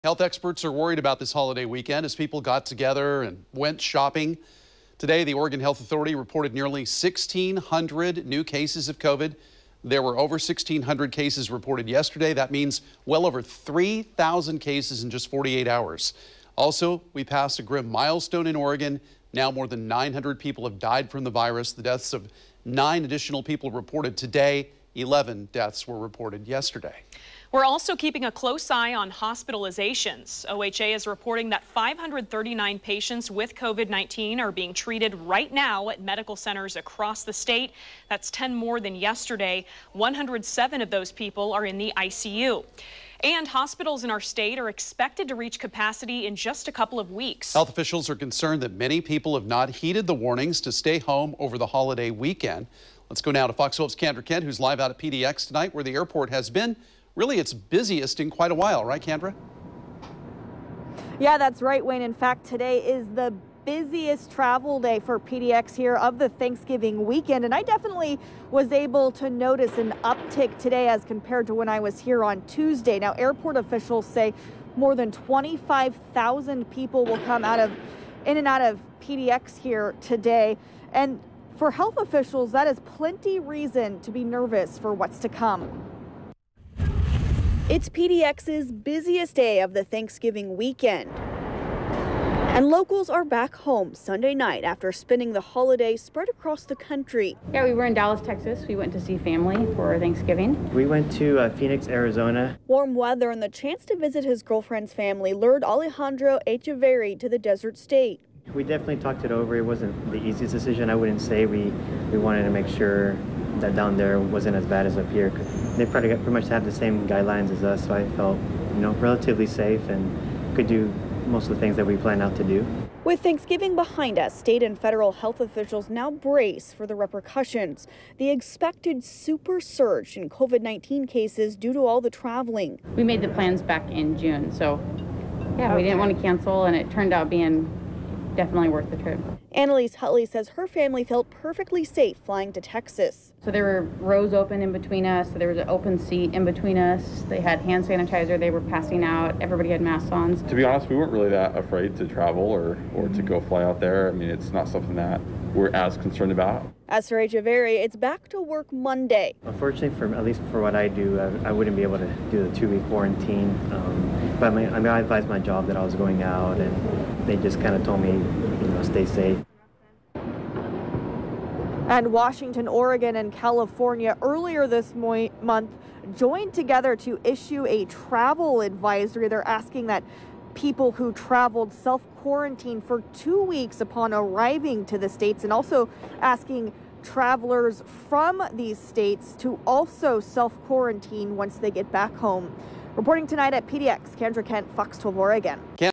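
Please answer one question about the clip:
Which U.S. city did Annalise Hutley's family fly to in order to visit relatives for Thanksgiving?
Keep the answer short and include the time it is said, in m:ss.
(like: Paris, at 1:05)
Dallas, Texas, at 1:37.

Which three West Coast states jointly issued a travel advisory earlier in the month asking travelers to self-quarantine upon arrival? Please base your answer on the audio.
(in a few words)
Washington, Oregon, and California.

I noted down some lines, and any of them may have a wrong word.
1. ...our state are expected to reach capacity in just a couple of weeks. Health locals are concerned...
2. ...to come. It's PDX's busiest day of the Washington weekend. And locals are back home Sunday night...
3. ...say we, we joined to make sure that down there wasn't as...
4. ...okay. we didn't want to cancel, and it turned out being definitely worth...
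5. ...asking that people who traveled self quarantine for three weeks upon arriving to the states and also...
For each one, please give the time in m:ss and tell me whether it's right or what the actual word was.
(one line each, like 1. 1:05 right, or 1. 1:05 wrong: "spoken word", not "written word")
1. 0:44 wrong: "officials", not "locals"
2. 1:25 wrong: "Thanksgiving", not "Washington"
3. 1:51 wrong: "wanted", not "joined"
4. 2:15 right
5. 2:59 wrong: "two", not "three".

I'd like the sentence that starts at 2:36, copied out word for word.
As for Echeverry, it's back to work Monday.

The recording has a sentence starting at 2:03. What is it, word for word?
With Thanksgiving behind us, state and federal health officials now brace for the repercussions.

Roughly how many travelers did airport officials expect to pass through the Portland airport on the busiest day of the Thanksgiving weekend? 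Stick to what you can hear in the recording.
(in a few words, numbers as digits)
more than 25,000.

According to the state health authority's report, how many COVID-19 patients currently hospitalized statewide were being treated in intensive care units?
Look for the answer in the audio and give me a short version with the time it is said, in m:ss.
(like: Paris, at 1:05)
107, at 0:39.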